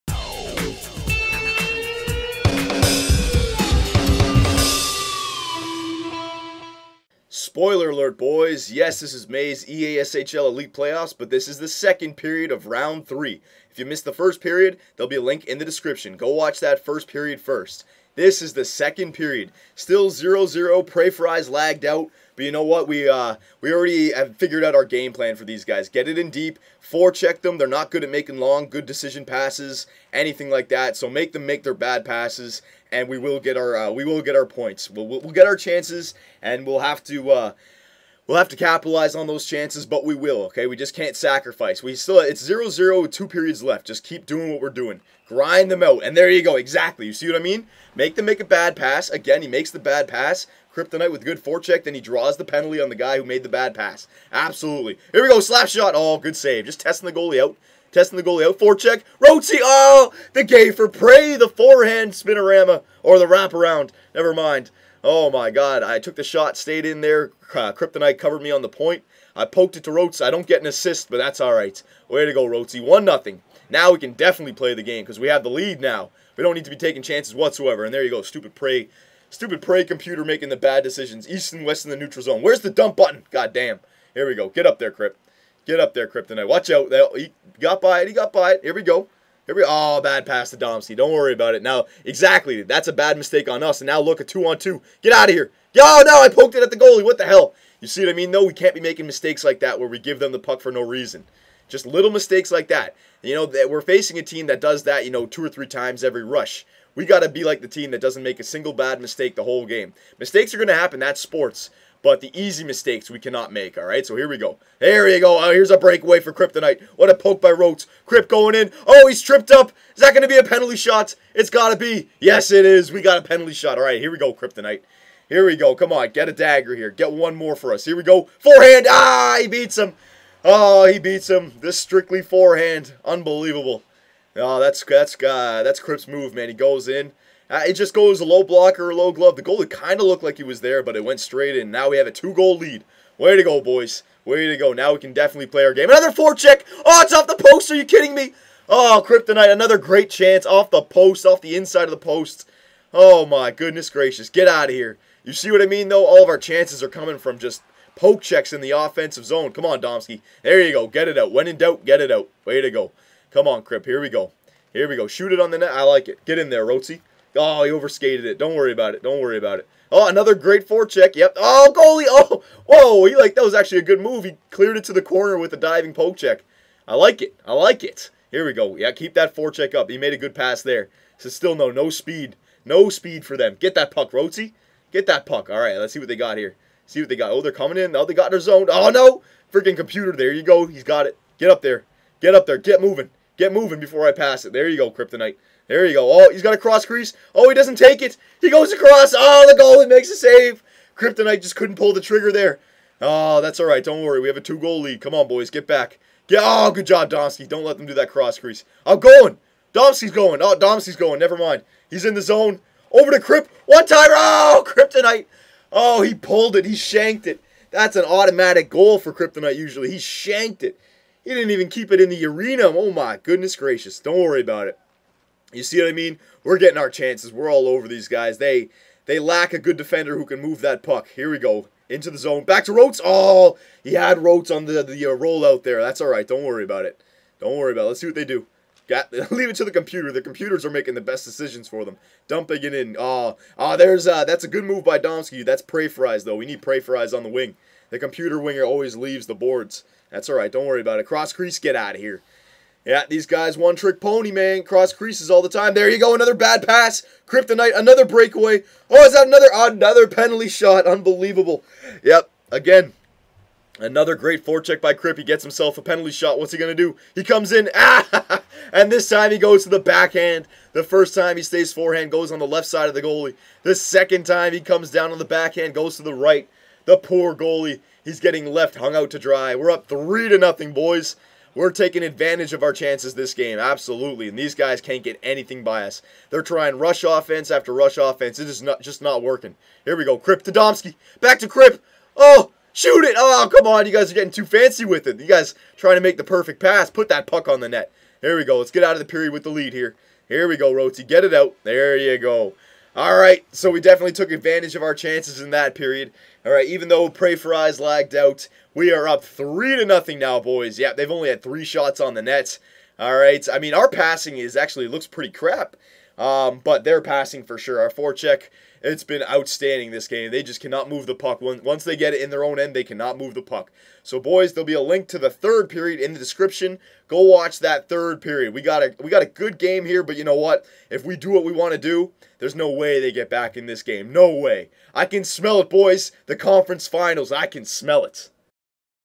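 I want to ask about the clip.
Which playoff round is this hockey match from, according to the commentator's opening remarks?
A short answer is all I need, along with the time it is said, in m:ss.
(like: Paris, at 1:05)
Round 3, at 0:12.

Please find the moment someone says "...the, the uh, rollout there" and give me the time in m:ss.
3:54.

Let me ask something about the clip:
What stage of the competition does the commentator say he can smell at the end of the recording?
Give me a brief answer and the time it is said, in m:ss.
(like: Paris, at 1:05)
The conference finals, at 5:36.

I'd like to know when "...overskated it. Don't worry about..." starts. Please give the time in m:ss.
2:47.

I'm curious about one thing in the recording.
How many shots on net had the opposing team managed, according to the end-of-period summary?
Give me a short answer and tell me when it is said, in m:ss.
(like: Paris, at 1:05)
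3, at 5:11.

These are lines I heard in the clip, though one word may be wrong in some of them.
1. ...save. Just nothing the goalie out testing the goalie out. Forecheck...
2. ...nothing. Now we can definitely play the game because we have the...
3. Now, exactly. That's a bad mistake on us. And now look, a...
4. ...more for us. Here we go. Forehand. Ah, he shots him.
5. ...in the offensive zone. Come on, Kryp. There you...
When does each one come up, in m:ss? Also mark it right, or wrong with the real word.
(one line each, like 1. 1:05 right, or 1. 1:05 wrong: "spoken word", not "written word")
1. 0:56 wrong: "testing", not "nothing"
2. 1:13 right
3. 1:31 right
4. 2:07 wrong: "beats", not "shots"
5. 2:38 wrong: "Domsky", not "Kryp".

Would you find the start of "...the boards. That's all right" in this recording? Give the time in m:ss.
4:09.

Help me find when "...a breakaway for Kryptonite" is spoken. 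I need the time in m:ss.
1:55.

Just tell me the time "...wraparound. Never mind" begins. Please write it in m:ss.
1:03.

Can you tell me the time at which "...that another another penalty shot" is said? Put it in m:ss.
4:19.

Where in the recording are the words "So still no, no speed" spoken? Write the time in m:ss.
3:01.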